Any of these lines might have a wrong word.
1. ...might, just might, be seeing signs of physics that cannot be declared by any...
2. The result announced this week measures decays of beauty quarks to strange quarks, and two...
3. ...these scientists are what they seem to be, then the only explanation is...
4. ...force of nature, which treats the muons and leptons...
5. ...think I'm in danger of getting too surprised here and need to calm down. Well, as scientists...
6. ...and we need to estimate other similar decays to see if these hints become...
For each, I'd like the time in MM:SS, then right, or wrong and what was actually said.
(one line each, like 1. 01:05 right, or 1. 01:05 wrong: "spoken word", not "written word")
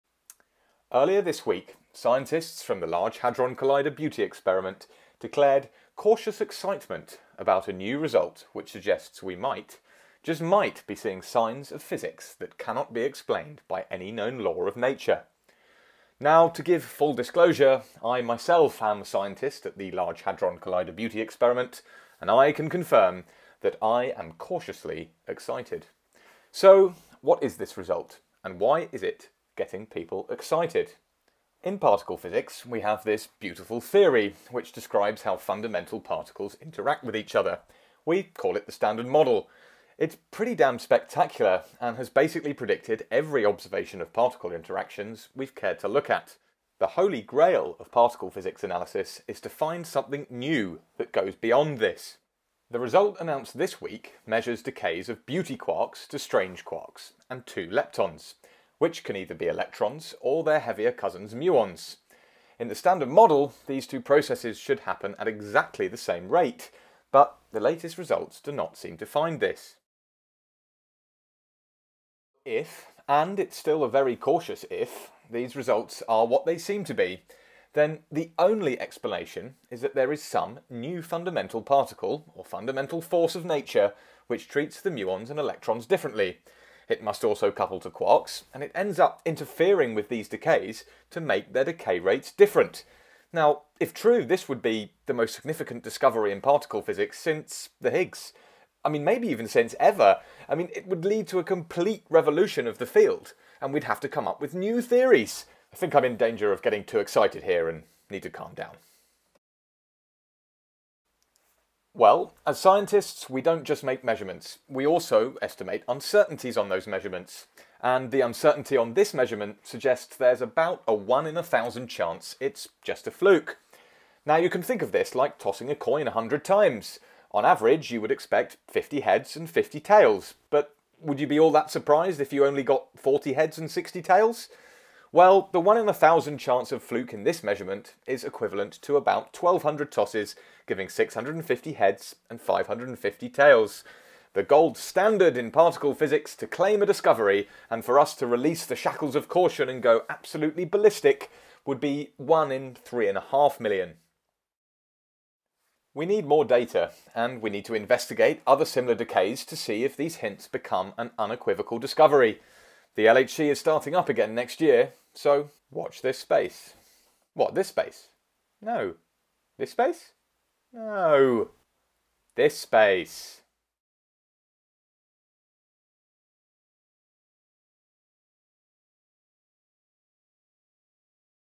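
1. 00:09 wrong: "explained", not "declared"
2. 00:52 right
3. 01:15 wrong: "results", not "scientists"
4. 01:22 wrong: "electrons", not "leptons"
5. 01:45 wrong: "excited", not "surprised"
6. 02:37 wrong: "investigate", not "estimate".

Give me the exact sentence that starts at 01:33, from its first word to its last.
Now, if true, this would be the most significant discovery in particle physics since the Higgs.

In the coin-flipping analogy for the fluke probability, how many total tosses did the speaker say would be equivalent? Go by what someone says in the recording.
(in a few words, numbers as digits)
1,200.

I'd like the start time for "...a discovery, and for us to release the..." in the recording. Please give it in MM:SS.
02:26.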